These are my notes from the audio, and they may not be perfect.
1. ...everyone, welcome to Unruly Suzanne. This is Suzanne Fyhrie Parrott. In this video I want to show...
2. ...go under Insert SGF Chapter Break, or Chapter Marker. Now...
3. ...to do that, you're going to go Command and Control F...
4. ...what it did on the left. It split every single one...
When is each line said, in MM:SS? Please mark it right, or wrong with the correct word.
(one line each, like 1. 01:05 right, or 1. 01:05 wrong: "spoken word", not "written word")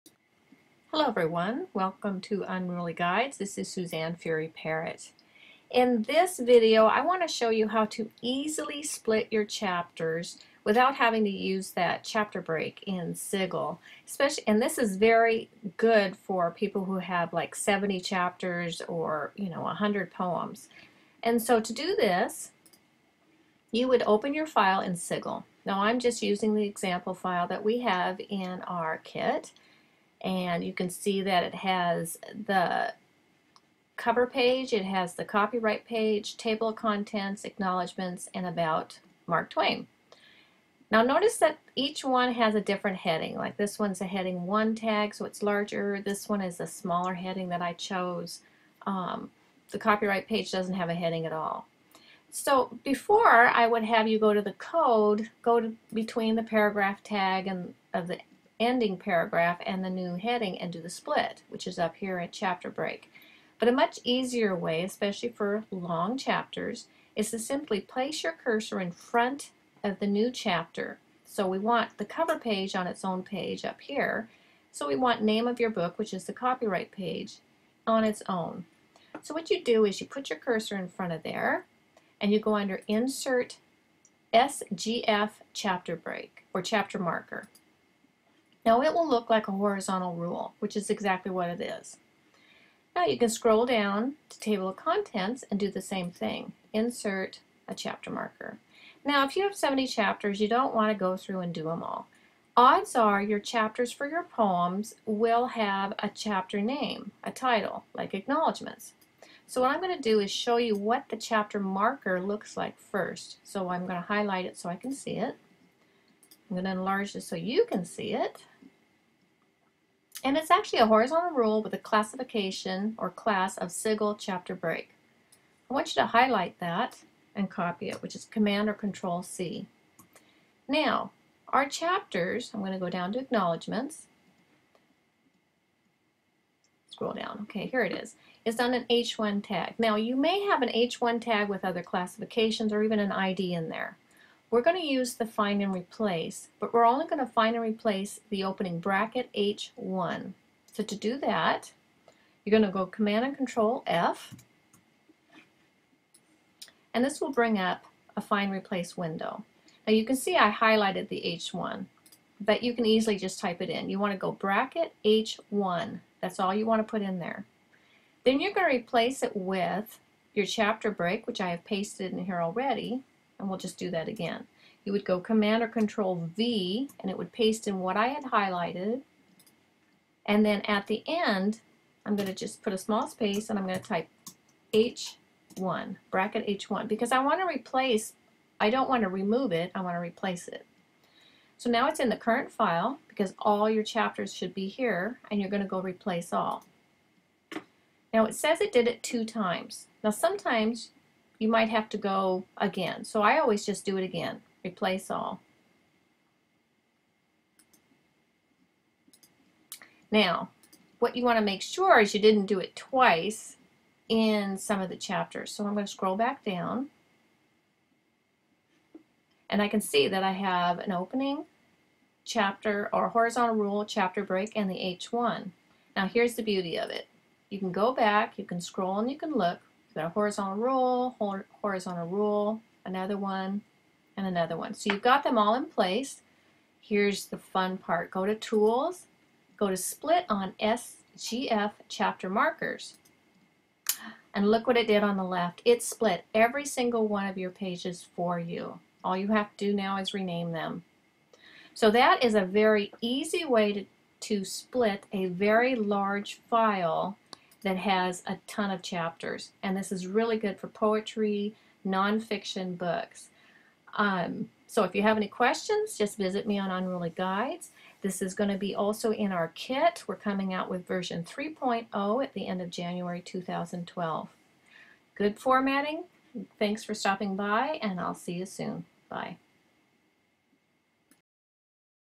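1. 00:01 wrong: "Guides", not "Suzanne"
2. 01:22 right
3. 02:30 right
4. 04:04 right.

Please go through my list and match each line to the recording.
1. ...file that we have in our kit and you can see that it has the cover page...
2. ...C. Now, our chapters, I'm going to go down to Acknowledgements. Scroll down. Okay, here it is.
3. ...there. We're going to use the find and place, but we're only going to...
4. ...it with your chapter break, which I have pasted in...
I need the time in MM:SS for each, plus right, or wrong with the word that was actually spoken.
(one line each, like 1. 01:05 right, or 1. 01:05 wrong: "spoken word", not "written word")
1. 00:27 right
2. 02:09 right
3. 02:23 wrong: "replace", not "place"
4. 02:49 right.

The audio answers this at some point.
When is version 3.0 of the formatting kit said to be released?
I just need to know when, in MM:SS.
04:32.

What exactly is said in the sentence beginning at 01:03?
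But a much easier way, especially for long chapters, is to simply place your cursor in front of the new chapter.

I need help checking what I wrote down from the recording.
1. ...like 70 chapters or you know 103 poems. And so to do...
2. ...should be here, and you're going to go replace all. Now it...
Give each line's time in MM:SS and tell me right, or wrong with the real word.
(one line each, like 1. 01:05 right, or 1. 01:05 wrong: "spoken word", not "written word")
1. 00:17 wrong: "100", not "103"
2. 03:14 right.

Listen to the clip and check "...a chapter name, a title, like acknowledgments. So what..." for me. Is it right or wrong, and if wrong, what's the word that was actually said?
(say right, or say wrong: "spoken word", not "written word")
right.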